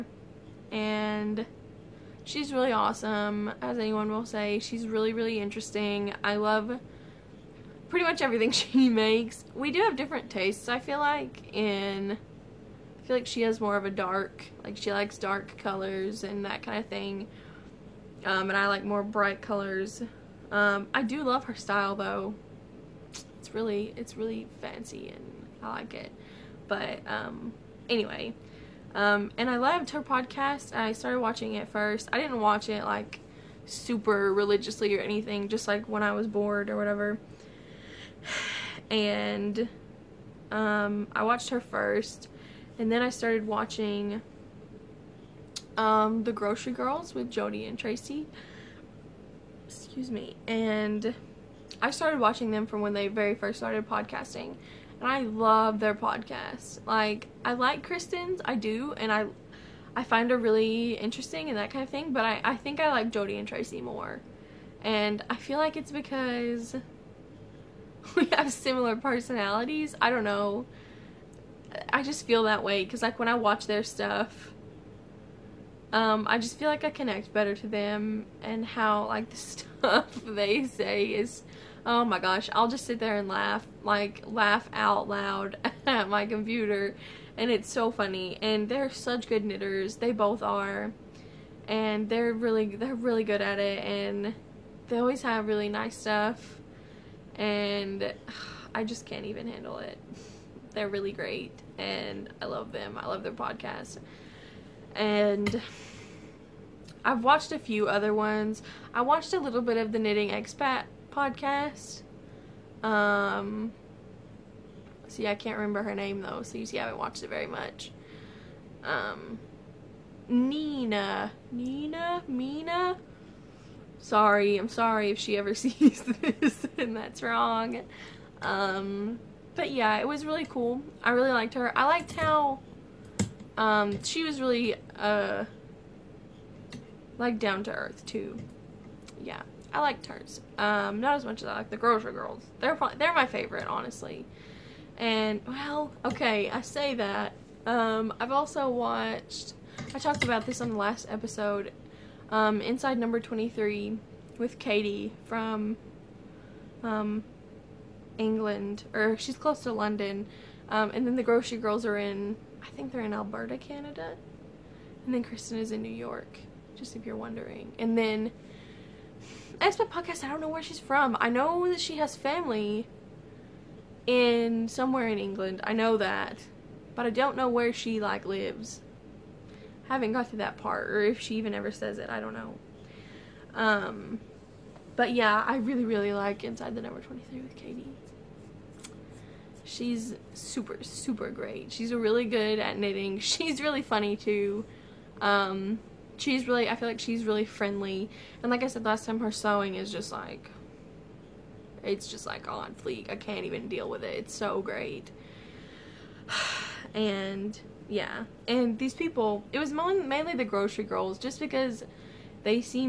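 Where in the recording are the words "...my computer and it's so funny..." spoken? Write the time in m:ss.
1:26.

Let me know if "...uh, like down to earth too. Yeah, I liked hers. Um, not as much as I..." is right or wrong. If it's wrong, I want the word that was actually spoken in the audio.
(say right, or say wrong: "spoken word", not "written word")
right.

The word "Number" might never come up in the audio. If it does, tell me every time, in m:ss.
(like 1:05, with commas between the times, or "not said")
2:32, 3:06.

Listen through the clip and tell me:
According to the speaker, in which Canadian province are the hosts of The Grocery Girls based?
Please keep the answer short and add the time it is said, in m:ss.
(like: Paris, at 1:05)
Alberta, at 2:43.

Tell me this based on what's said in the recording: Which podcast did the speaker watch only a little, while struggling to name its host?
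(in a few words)
Knitting Expat.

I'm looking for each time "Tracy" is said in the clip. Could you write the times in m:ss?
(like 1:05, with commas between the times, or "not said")
0:47, 1:03.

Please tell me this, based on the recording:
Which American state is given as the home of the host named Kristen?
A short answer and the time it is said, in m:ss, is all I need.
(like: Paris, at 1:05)
New York, at 2:45.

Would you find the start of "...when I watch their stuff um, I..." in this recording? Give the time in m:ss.
1:13.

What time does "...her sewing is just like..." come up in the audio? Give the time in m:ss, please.
3:19.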